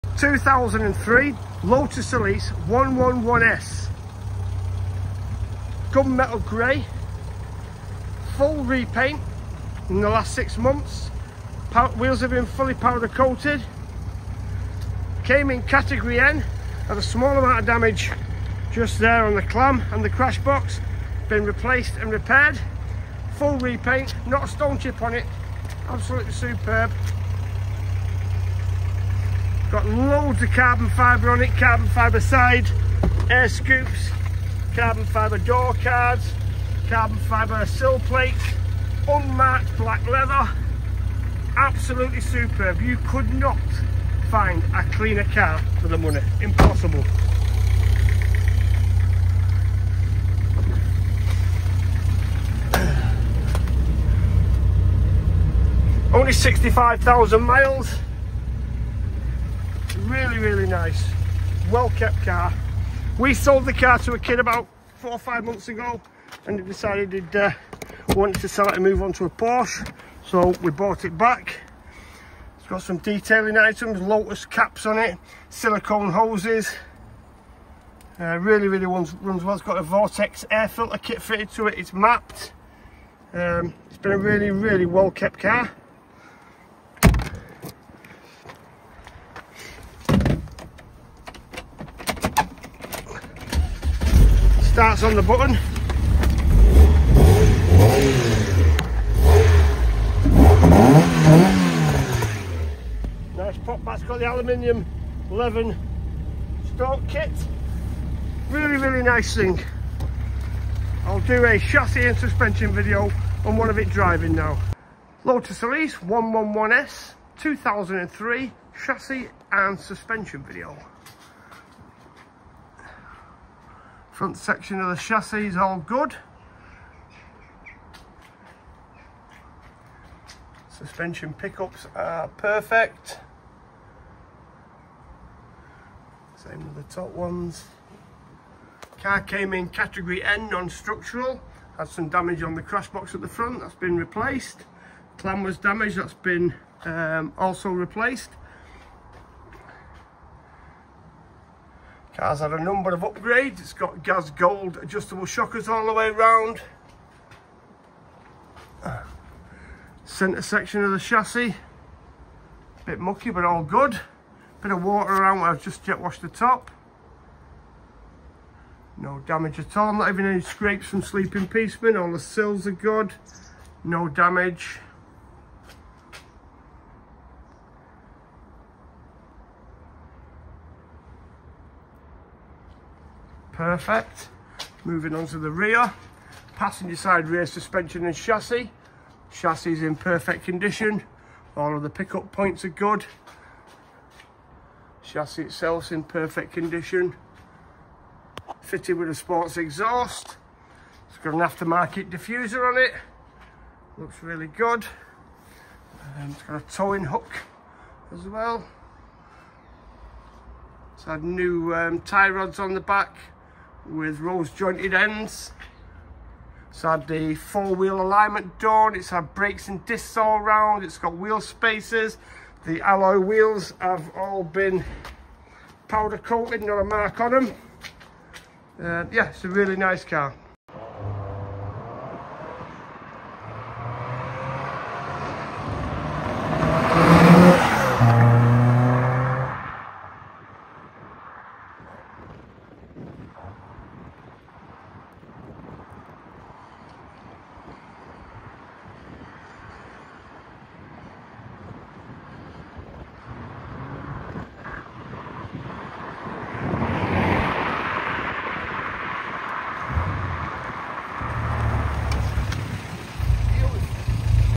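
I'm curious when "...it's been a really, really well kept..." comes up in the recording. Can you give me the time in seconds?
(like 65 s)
83 s.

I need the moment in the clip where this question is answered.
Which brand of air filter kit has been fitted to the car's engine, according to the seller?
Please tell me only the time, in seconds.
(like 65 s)
79 s.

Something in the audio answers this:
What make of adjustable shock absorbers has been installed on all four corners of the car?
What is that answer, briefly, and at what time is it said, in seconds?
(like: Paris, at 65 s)
Gaz Gold, at 154 s.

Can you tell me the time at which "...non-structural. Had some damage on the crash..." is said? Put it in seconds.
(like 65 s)
140 s.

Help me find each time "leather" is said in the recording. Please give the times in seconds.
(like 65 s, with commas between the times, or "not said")
40 s.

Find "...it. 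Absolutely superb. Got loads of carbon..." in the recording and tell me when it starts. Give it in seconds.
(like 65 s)
25 s.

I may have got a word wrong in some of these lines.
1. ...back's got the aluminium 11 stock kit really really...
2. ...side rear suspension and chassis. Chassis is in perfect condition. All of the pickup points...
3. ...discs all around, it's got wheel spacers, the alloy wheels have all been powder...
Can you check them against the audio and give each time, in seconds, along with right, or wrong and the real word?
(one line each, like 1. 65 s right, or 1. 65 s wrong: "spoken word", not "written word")
1. 103 s right
2. 186 s right
3. 219 s right.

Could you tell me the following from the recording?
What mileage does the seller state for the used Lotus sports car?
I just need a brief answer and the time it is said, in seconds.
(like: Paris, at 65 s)
65,000 miles, at 56 s.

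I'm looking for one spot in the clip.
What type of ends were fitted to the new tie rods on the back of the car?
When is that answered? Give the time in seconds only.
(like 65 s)
214 s.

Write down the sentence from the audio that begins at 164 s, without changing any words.
Bit of water around where I've just jet washed the top.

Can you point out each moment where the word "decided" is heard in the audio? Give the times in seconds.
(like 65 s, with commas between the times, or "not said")
66 s.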